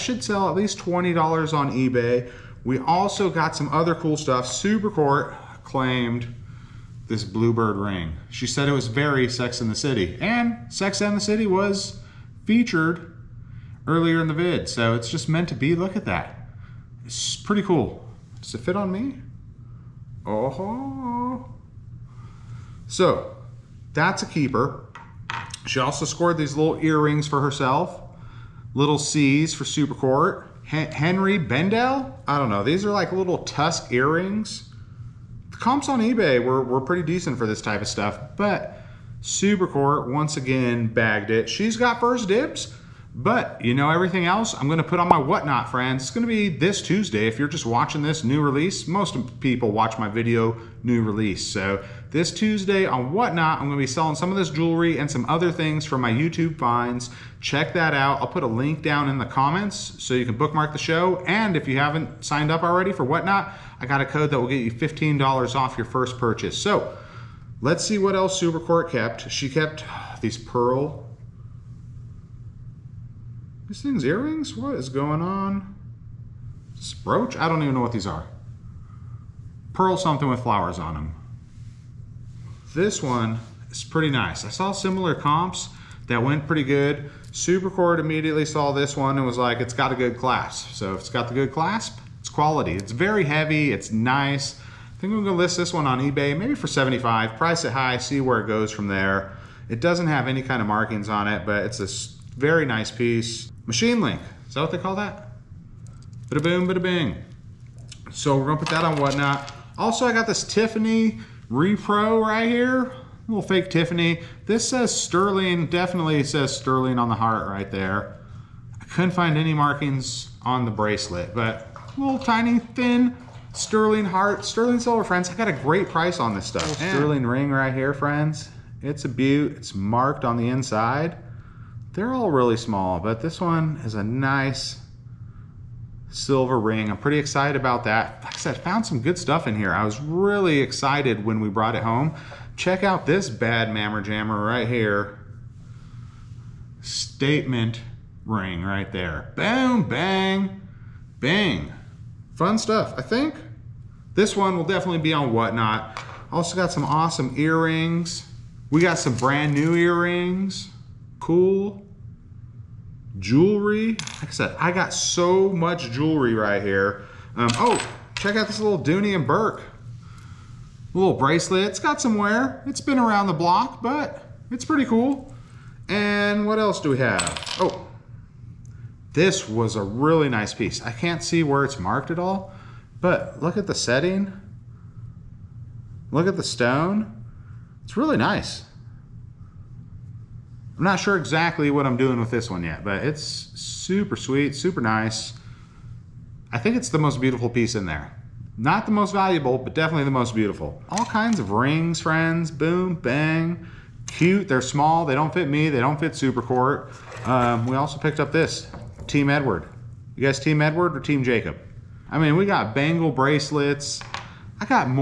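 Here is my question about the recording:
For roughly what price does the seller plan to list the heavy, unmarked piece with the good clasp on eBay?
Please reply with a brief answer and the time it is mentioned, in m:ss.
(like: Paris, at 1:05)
75, at 1:36.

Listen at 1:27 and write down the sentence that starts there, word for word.
Supercourt immediately saw this one and was like, it's got a good clasp.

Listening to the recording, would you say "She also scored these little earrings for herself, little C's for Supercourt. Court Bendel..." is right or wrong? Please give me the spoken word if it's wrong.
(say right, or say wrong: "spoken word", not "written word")
wrong: "Henri", not "Bendel".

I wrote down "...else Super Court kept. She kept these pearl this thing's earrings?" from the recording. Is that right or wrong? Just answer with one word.
right.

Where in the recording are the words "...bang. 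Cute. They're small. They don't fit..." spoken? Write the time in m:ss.
3:22.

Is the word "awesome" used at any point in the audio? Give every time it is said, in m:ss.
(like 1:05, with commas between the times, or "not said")
2:36.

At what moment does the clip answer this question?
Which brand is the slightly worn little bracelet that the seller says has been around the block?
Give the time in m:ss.
2:48.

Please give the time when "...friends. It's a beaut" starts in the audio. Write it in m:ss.
2:07.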